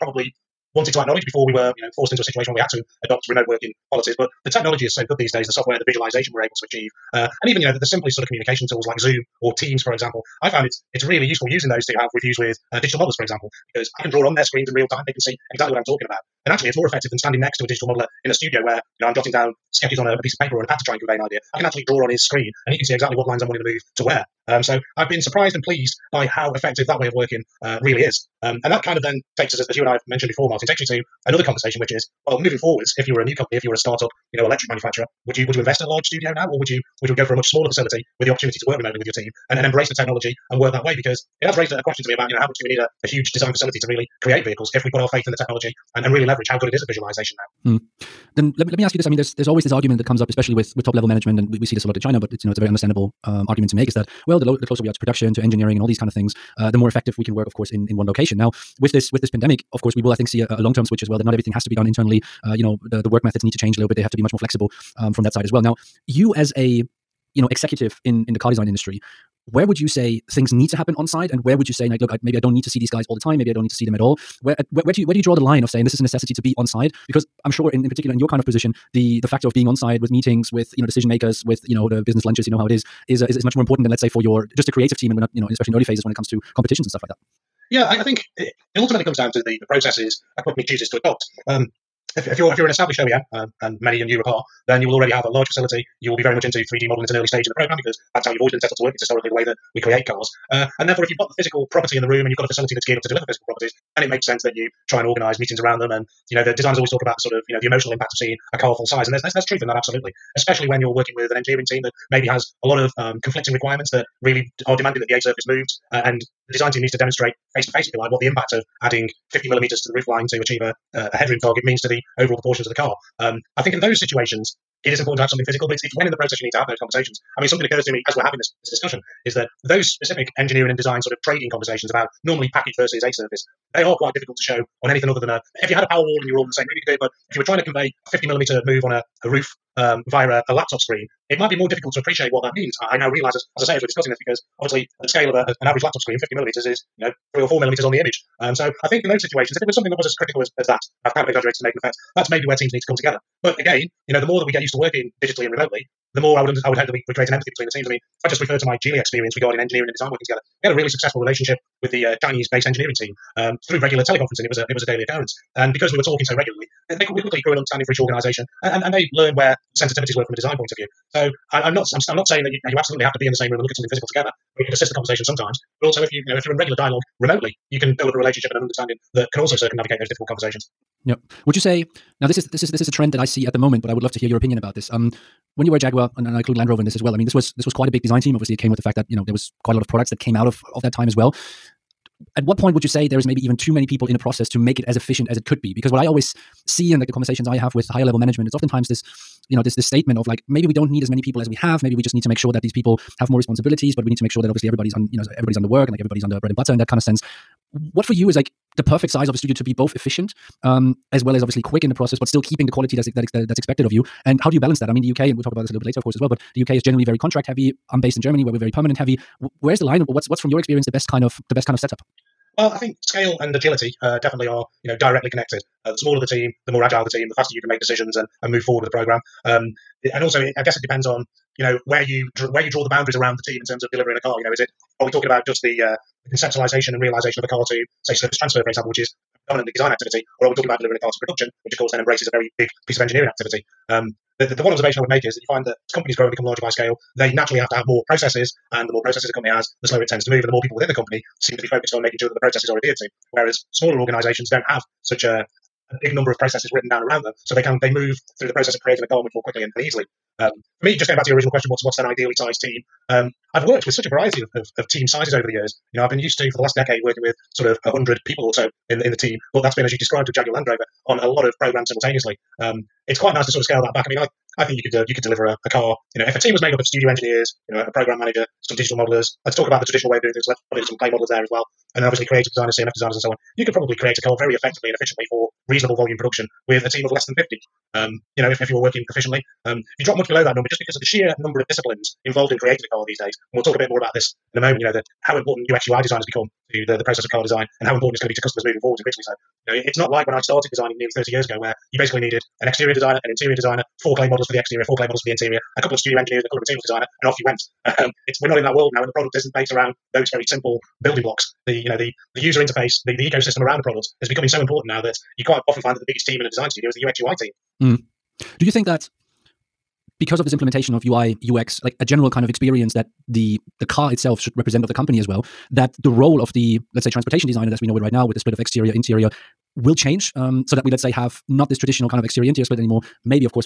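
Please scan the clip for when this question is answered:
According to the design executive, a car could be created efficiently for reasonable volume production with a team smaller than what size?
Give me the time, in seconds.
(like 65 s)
287 s.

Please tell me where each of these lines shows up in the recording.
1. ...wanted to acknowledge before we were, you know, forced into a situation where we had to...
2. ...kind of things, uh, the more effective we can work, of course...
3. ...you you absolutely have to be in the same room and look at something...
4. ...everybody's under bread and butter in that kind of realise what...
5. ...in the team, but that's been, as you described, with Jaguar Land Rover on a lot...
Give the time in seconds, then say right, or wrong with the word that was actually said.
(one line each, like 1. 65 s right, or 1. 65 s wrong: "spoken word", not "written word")
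1. 0 s right
2. 55 s right
3. 172 s right
4. 206 s wrong: "sense", not "realise"
5. 269 s right.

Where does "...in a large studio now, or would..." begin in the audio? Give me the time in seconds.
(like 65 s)
35 s.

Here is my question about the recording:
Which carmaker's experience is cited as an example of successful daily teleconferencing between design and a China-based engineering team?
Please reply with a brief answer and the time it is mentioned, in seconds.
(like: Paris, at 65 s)
Geely, at 158 s.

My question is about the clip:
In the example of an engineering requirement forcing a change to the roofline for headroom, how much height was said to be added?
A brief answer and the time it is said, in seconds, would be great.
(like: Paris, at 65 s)
50 millimeters, at 119 s.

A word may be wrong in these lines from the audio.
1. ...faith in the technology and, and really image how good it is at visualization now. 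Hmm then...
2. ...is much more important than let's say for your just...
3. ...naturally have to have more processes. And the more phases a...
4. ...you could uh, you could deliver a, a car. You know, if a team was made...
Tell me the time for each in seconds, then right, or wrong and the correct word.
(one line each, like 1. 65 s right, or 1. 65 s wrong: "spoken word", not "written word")
1. 45 s wrong: "leverage", not "image"
2. 83 s right
3. 247 s wrong: "processes", not "phases"
4. 274 s right.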